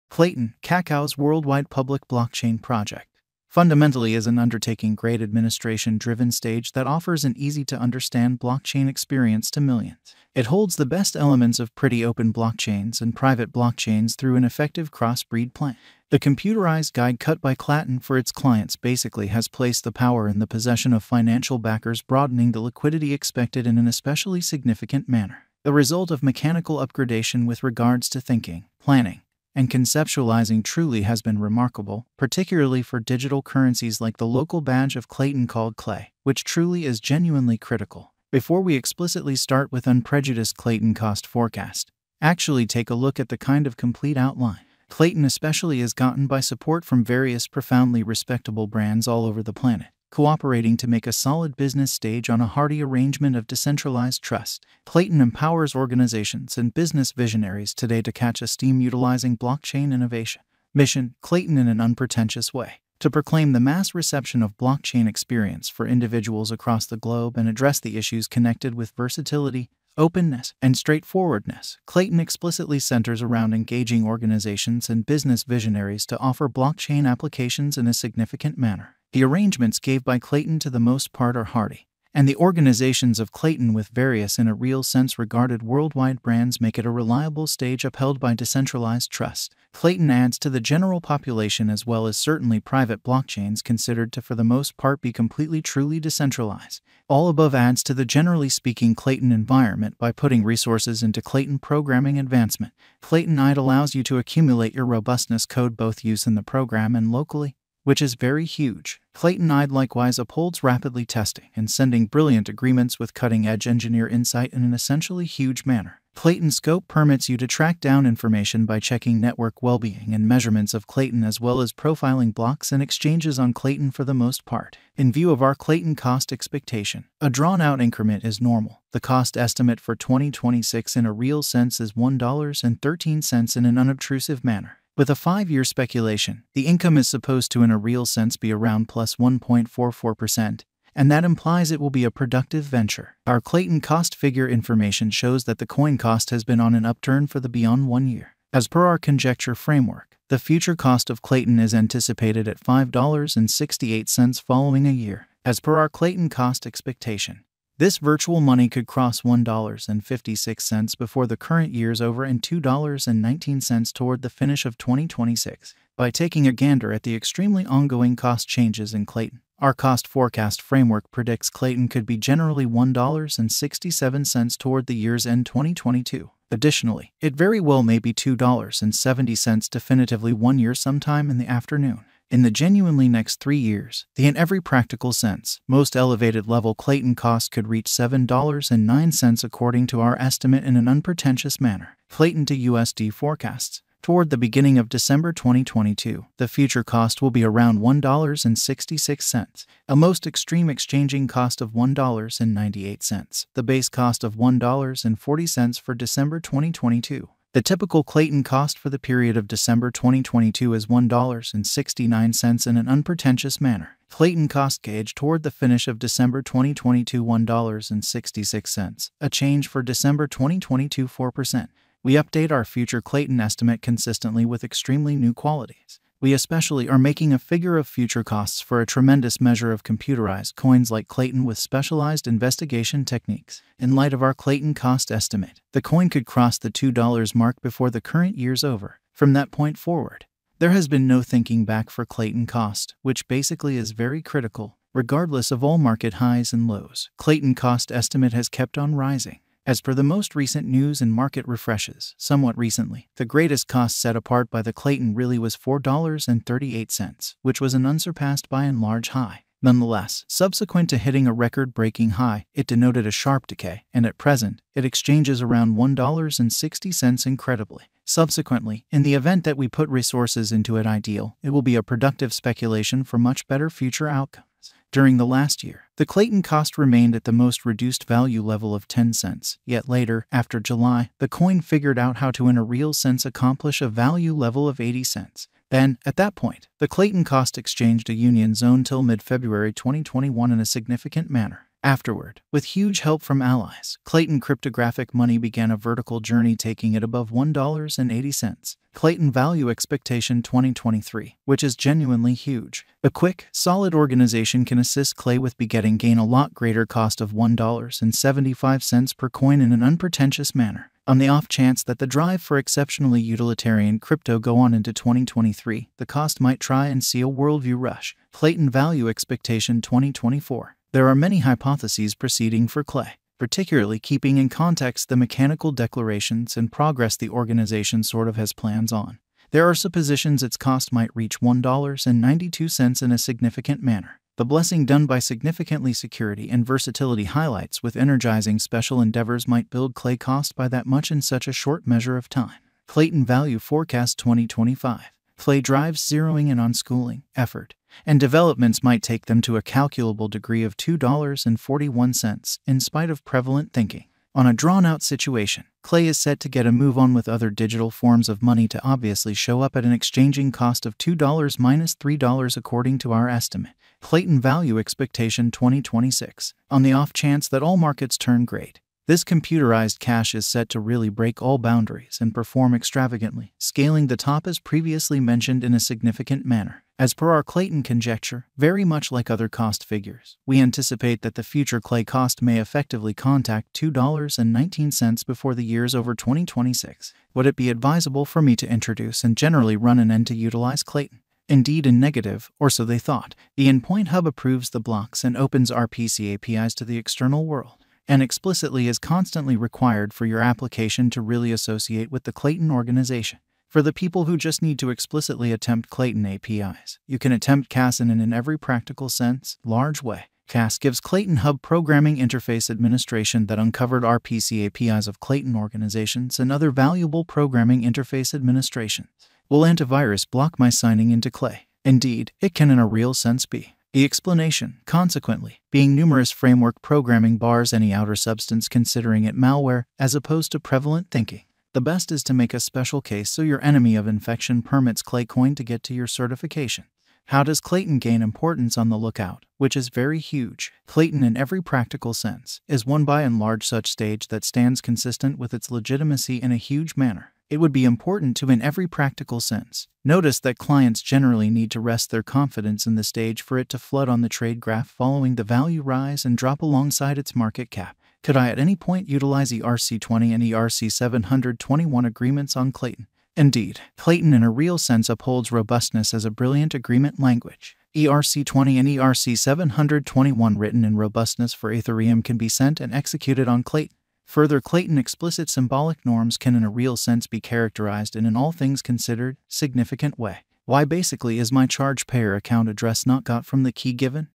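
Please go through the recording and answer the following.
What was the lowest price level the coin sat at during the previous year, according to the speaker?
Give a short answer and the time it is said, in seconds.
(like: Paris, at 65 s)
10 cents, at 278 s.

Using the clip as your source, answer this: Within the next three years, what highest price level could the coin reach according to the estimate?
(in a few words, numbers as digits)
$7.09.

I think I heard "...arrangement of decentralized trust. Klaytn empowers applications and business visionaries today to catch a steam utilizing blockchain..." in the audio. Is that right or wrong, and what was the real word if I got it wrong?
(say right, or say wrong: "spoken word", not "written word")
wrong: "organizations", not "applications".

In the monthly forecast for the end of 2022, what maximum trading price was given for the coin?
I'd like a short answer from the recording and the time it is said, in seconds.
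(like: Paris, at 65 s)
$1.98, at 201 s.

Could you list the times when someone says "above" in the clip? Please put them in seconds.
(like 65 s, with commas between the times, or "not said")
97 s, 297 s.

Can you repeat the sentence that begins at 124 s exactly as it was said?
In view of our Klaytn cost expectation, a drawn-out increment is normal.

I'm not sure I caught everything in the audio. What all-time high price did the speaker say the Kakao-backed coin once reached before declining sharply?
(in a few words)
$4.38.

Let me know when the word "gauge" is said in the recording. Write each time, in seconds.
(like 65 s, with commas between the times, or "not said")
214 s.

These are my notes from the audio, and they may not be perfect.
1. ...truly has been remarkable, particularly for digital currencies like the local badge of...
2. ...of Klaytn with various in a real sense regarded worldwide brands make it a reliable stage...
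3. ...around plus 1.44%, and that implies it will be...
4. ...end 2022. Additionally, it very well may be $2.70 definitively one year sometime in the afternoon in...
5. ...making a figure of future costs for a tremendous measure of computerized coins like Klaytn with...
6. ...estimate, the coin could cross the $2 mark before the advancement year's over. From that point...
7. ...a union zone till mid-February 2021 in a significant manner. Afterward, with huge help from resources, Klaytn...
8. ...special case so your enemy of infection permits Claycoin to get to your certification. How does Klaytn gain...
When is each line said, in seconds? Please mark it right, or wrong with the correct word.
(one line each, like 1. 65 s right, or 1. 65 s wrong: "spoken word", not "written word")
1. 30 s right
2. 83 s right
3. 138 s right
4. 175 s right
5. 226 s right
6. 235 s wrong: "current", not "advancement"
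7. 288 s wrong: "allies", not "resources"
8. 432 s right.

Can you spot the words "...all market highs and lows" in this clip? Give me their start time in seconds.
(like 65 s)
245 s.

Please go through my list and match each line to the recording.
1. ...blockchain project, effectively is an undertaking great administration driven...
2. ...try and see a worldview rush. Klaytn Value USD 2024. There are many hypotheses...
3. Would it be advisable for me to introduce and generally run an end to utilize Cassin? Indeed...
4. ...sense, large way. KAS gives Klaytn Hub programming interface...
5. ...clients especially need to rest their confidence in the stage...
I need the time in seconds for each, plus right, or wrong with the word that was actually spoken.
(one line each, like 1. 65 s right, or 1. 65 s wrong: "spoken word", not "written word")
1. 2 s wrong: "fundamentally", not "effectively"
2. 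316 s wrong: "Expectation", not "USD"
3. 387 s wrong: "Klaytn", not "Cassin"
4. 409 s right
5. 450 s wrong: "generally", not "especially".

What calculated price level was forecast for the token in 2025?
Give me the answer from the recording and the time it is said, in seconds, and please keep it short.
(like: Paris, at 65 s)
$2.41, at 350 s.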